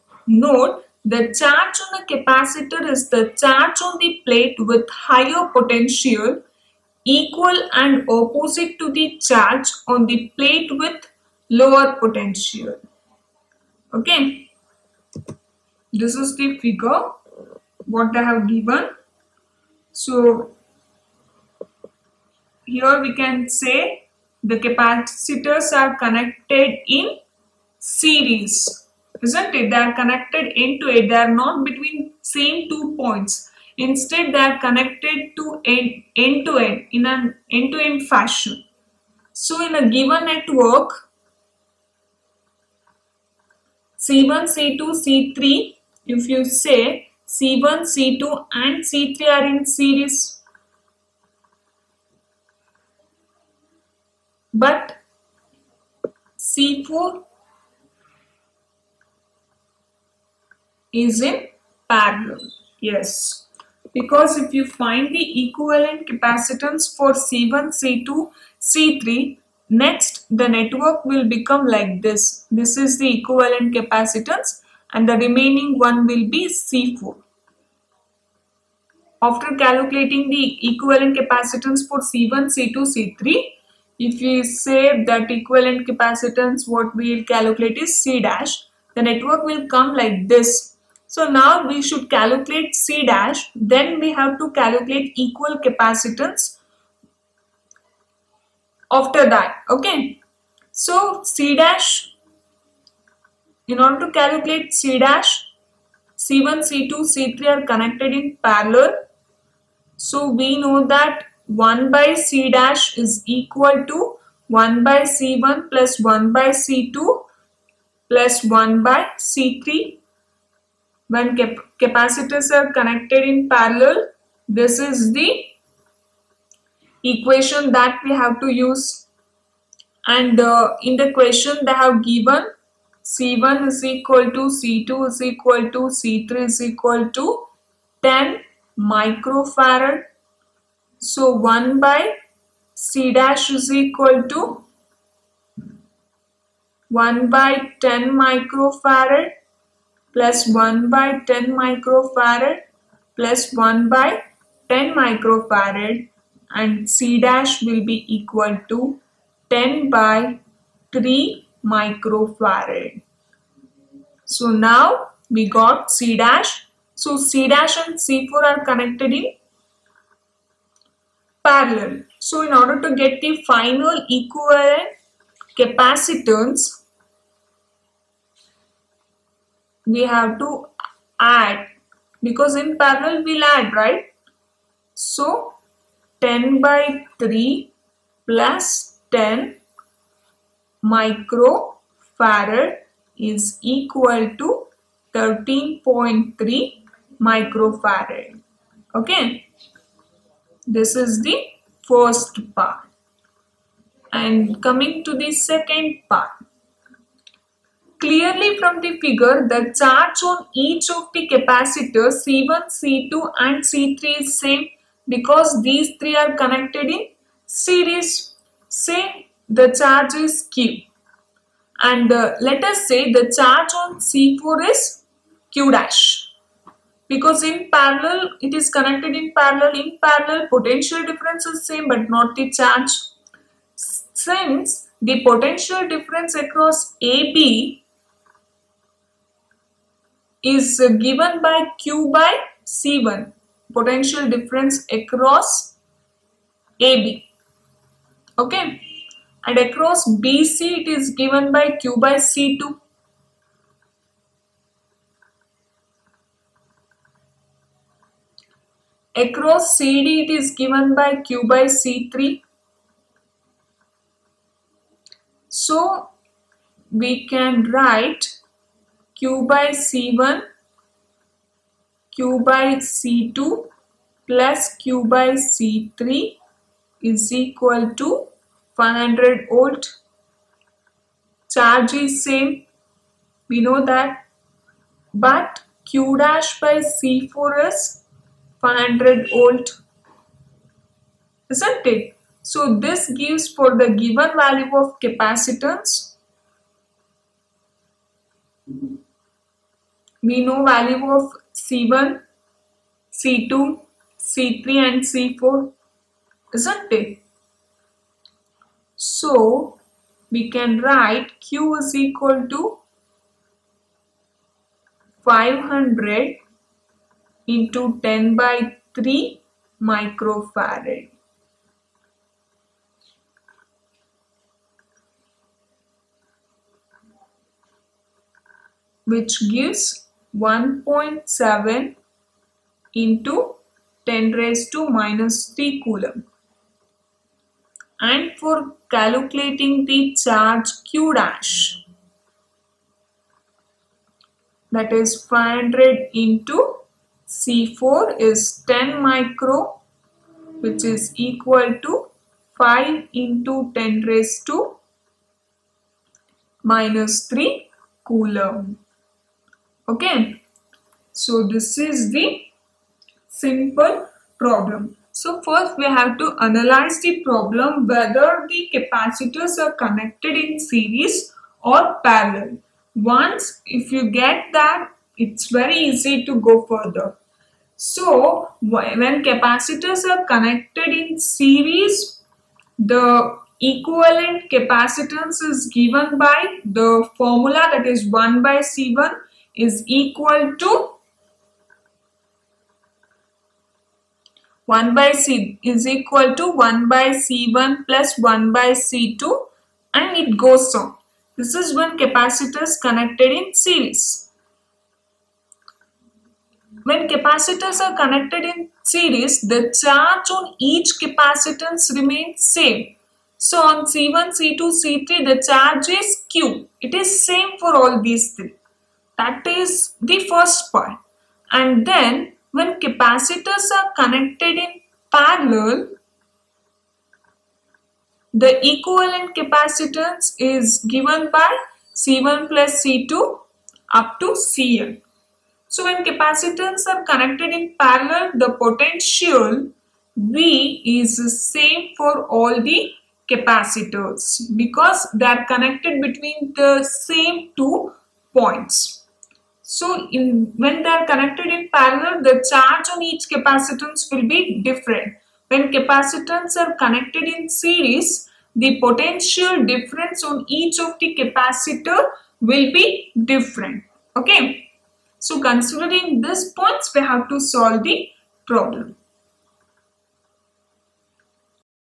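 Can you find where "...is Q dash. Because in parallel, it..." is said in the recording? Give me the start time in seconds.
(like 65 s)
224 s.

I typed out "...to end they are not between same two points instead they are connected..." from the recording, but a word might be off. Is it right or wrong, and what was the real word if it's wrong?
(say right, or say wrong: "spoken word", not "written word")
right.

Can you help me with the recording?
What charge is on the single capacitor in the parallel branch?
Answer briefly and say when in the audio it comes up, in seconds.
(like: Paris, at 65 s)
5 × 10^-3 coulomb, at 352 s.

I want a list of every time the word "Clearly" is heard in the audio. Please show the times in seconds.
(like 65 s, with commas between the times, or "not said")
207 s.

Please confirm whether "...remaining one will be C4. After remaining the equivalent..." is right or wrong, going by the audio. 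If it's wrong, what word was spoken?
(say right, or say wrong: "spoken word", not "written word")
wrong: "calculating", not "remaining".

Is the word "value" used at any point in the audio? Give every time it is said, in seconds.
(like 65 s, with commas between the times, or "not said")
294 s, 300 s.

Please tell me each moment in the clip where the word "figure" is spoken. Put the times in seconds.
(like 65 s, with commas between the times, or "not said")
16 s, 208 s.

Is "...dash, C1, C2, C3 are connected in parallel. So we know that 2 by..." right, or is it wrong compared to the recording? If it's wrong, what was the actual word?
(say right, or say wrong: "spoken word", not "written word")
wrong: "1", not "2".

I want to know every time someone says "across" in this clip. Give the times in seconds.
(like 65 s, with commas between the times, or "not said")
236 s, 244 s, 249 s, 259 s.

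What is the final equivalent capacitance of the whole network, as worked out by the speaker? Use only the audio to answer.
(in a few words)
13.3 microfarad.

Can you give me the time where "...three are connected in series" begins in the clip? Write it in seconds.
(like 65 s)
215 s.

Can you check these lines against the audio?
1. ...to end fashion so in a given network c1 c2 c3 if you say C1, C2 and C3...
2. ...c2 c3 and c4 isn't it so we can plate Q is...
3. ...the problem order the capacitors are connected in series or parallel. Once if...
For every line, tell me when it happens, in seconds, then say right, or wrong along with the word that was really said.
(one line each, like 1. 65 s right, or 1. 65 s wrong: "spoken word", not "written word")
1. 37 s right
2. 303 s wrong: "write", not "plate"
3. 366 s wrong: "whether", not "order".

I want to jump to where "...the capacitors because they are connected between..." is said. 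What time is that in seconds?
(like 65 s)
442 s.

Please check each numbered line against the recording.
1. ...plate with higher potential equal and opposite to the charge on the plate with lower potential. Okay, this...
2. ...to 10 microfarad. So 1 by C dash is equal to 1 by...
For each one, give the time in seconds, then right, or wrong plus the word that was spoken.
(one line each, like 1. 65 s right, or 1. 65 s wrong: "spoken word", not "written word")
1. 4 s right
2. 137 s right.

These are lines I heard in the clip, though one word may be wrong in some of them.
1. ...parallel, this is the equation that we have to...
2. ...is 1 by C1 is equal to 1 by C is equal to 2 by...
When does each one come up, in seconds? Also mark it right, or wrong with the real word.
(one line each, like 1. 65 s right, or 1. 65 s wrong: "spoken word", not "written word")
1. 123 s right
2. 387 s wrong: "1", not "2".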